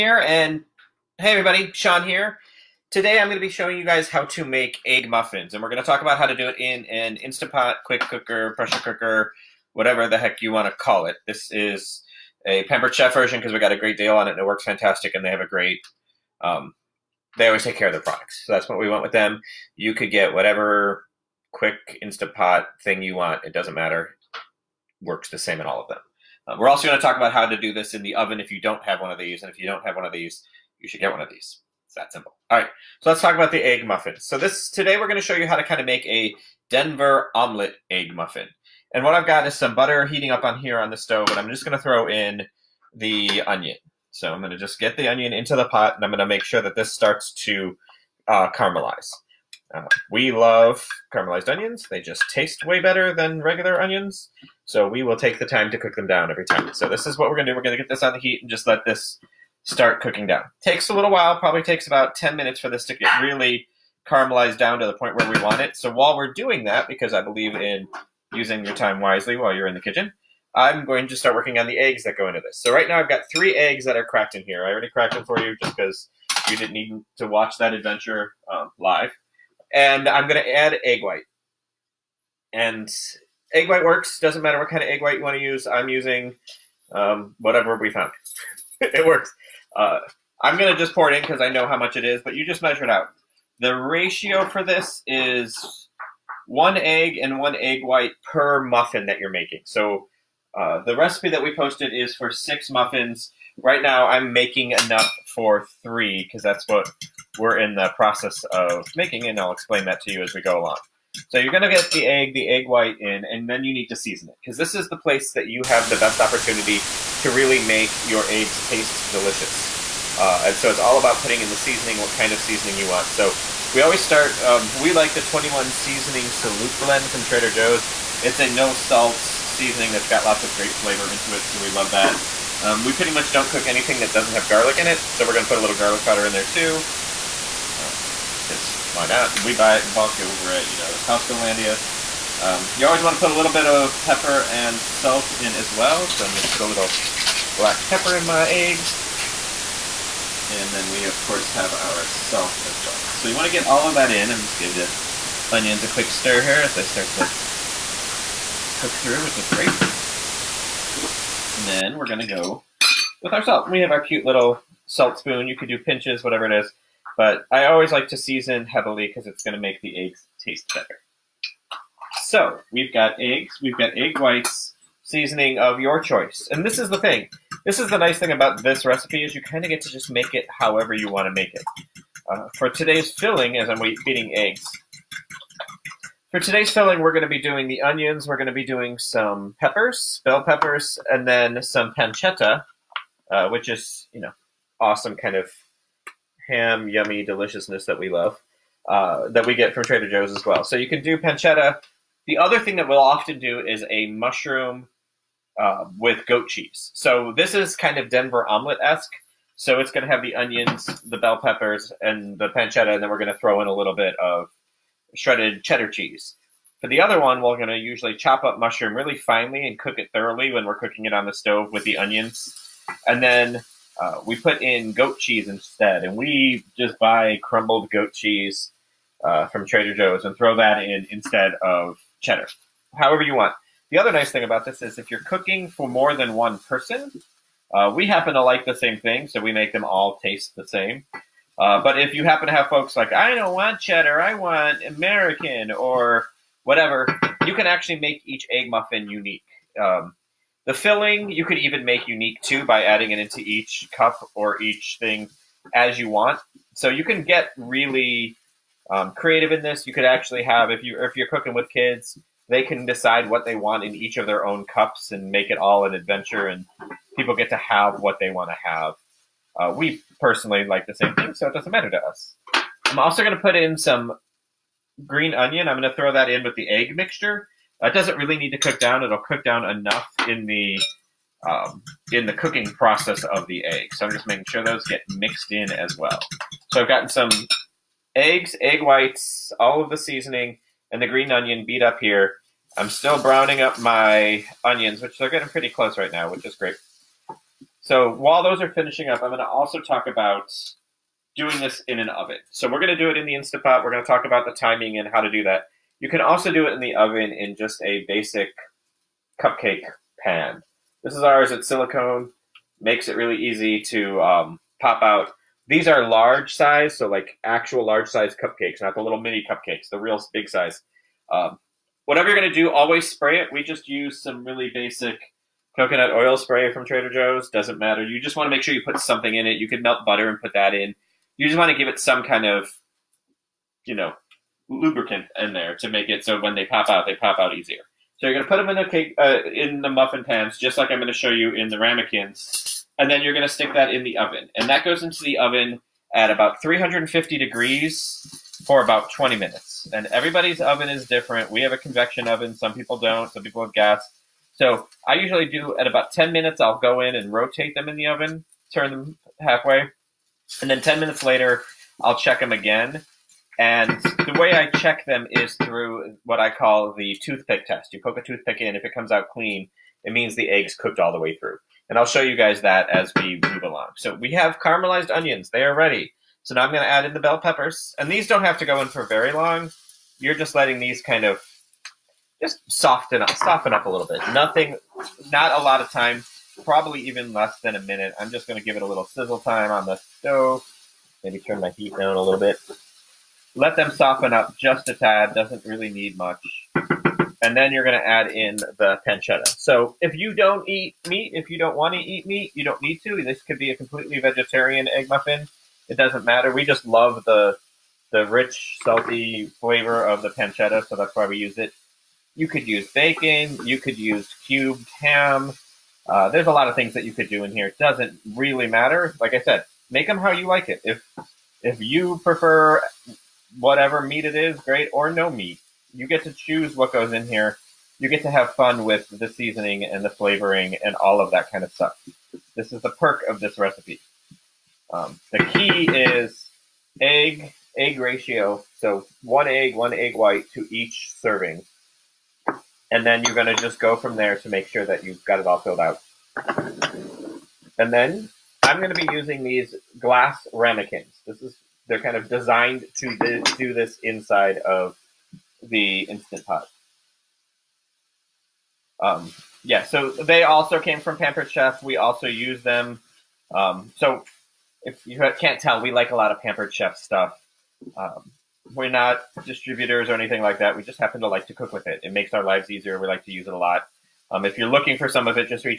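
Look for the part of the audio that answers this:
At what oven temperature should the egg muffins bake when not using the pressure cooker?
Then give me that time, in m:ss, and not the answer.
5:46.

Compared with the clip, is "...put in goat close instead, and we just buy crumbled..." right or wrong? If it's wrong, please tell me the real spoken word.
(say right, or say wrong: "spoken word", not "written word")
wrong: "cheese", not "close".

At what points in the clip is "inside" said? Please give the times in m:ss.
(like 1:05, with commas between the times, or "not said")
7:34.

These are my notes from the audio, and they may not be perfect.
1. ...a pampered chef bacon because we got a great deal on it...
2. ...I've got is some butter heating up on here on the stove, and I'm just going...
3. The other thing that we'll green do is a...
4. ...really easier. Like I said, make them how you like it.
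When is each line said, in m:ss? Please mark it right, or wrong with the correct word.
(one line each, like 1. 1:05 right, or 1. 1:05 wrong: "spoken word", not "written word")
1. 0:12 wrong: "version", not "bacon"
2. 0:39 right
3. 3:22 wrong: "often", not "green"
4. 6:58 wrong: "matter", not "easier".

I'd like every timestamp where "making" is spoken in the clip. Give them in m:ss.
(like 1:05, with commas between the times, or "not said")
1:39, 1:44, 1:48, 4:44.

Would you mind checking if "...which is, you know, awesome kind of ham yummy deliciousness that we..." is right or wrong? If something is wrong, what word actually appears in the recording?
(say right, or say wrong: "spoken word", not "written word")
right.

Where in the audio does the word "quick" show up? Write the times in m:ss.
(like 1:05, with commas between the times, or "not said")
0:07, 0:21, 2:35.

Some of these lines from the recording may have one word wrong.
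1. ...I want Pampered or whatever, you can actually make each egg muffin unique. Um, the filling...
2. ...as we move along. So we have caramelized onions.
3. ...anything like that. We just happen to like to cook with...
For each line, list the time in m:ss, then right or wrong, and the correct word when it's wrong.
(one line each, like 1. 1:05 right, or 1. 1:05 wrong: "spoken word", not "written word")
1. 4:04 wrong: "American", not "Pampered"
2. 6:12 right
3. 7:50 right.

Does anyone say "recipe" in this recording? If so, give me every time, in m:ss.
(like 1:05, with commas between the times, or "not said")
1:40, 2:58, 7:13.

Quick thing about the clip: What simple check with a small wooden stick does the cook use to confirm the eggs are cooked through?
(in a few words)
toothpick test.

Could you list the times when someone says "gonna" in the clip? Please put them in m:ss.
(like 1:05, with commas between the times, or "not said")
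2:26, 5:22.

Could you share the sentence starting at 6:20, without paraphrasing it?
You're just letting these kind of just soften up, soften up a little bit.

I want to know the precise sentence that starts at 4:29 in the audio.
Uh, we personally like the same thing, so it doesn't matter to us.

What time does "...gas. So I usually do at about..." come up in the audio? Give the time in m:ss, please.
5:53.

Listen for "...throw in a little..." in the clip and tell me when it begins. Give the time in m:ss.
3:33.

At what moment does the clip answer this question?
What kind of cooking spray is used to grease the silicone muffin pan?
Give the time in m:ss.
5:25.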